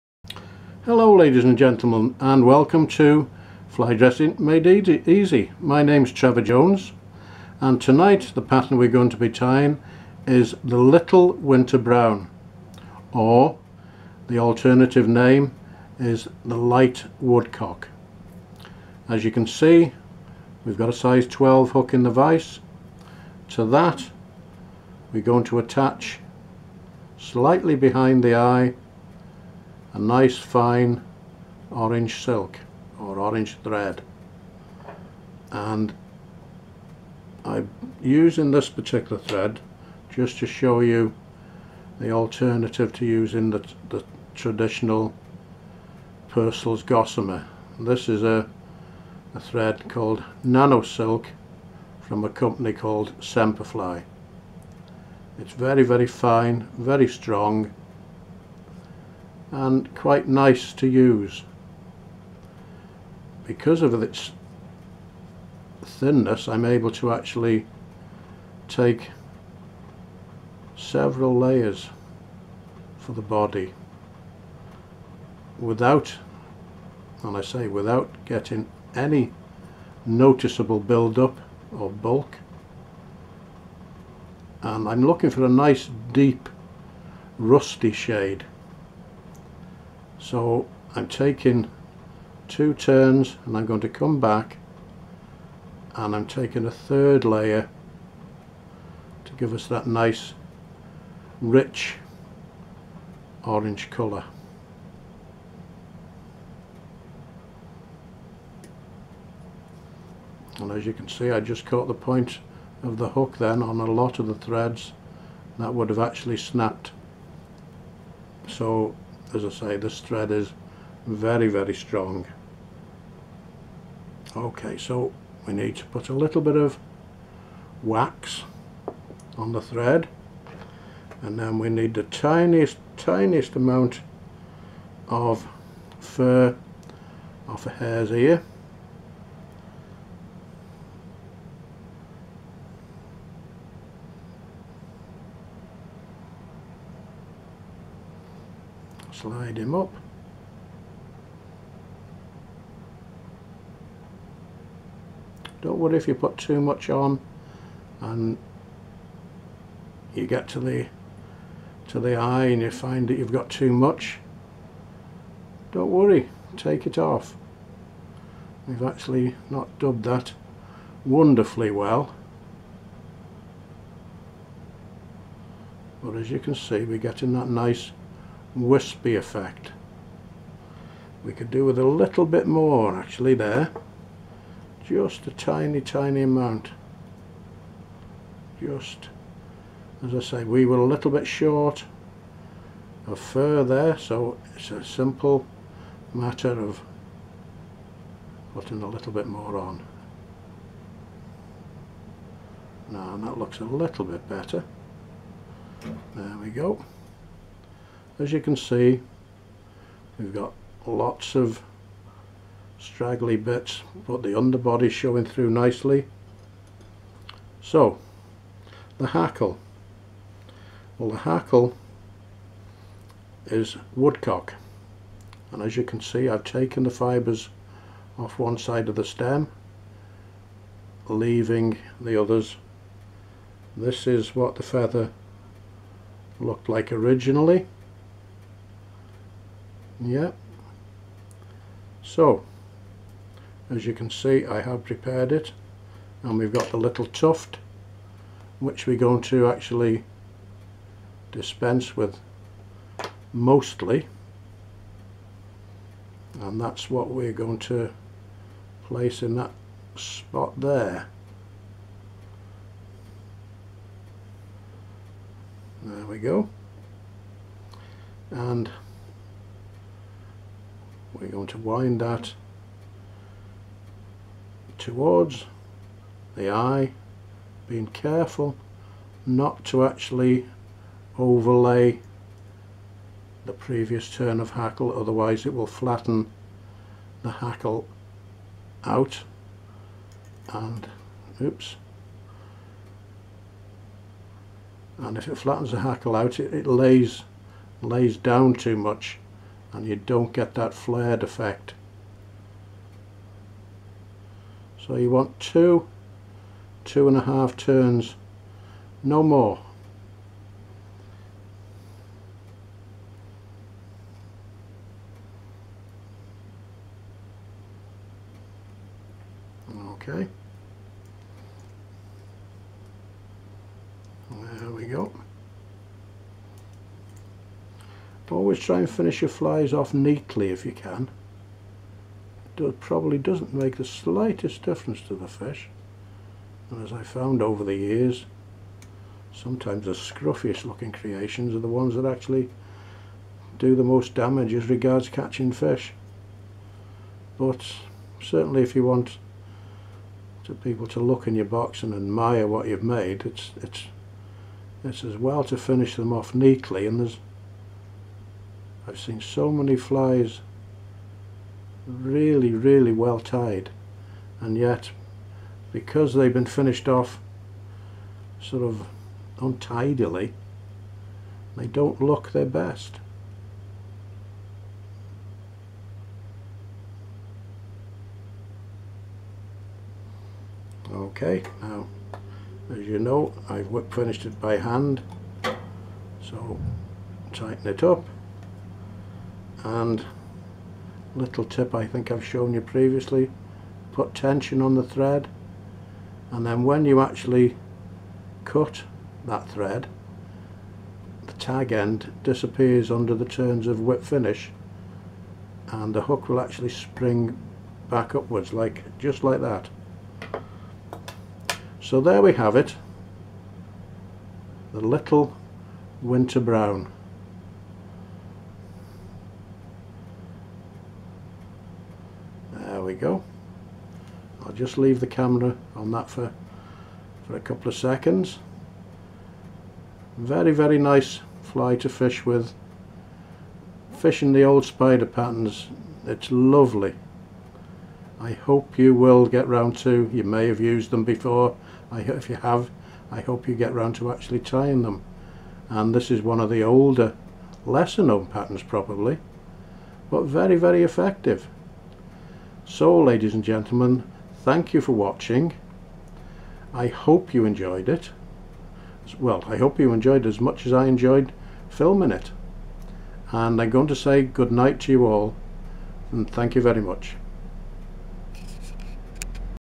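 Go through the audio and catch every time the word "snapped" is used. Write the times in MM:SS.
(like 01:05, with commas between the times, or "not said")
01:56.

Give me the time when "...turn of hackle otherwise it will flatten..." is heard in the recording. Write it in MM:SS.
04:44.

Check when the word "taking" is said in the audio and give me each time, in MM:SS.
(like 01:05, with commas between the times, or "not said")
01:31, 01:36.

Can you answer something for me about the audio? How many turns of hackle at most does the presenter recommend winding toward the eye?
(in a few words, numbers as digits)
2 and a half.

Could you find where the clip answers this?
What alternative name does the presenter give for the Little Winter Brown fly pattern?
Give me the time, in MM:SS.
00:16.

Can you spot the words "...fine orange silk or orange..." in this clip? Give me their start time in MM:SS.
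00:30.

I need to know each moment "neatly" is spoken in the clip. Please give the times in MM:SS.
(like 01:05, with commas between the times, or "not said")
05:29, 05:56.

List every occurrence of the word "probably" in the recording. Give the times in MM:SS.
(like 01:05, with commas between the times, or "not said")
05:32, 07:28.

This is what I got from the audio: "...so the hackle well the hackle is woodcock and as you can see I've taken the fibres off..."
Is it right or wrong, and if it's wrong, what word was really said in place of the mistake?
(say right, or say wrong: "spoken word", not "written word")
right.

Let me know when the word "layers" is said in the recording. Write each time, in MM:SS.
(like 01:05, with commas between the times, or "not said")
01:11, 01:37.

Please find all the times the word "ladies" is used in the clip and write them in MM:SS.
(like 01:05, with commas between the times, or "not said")
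00:01, 07:33.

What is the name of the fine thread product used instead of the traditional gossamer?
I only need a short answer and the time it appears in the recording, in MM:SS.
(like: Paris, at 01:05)
Nano Silk, at 00:50.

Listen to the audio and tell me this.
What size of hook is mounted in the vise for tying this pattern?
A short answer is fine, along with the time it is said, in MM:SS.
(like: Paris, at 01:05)
12, at 00:20.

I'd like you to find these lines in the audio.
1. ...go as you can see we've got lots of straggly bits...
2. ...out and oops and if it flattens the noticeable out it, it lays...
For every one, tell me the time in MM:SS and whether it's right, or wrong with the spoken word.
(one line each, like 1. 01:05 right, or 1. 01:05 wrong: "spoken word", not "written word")
1. 03:26 right
2. 04:48 wrong: "hackle", not "noticeable".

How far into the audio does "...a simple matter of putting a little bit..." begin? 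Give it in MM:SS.
03:14.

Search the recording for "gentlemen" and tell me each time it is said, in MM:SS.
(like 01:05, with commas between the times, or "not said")
00:01, 07:33.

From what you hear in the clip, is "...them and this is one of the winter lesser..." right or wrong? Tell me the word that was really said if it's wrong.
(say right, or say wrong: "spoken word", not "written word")
wrong: "older", not "winter".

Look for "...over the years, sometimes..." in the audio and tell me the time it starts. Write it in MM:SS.
05:37.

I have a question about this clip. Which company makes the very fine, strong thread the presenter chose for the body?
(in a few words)
Semperfli.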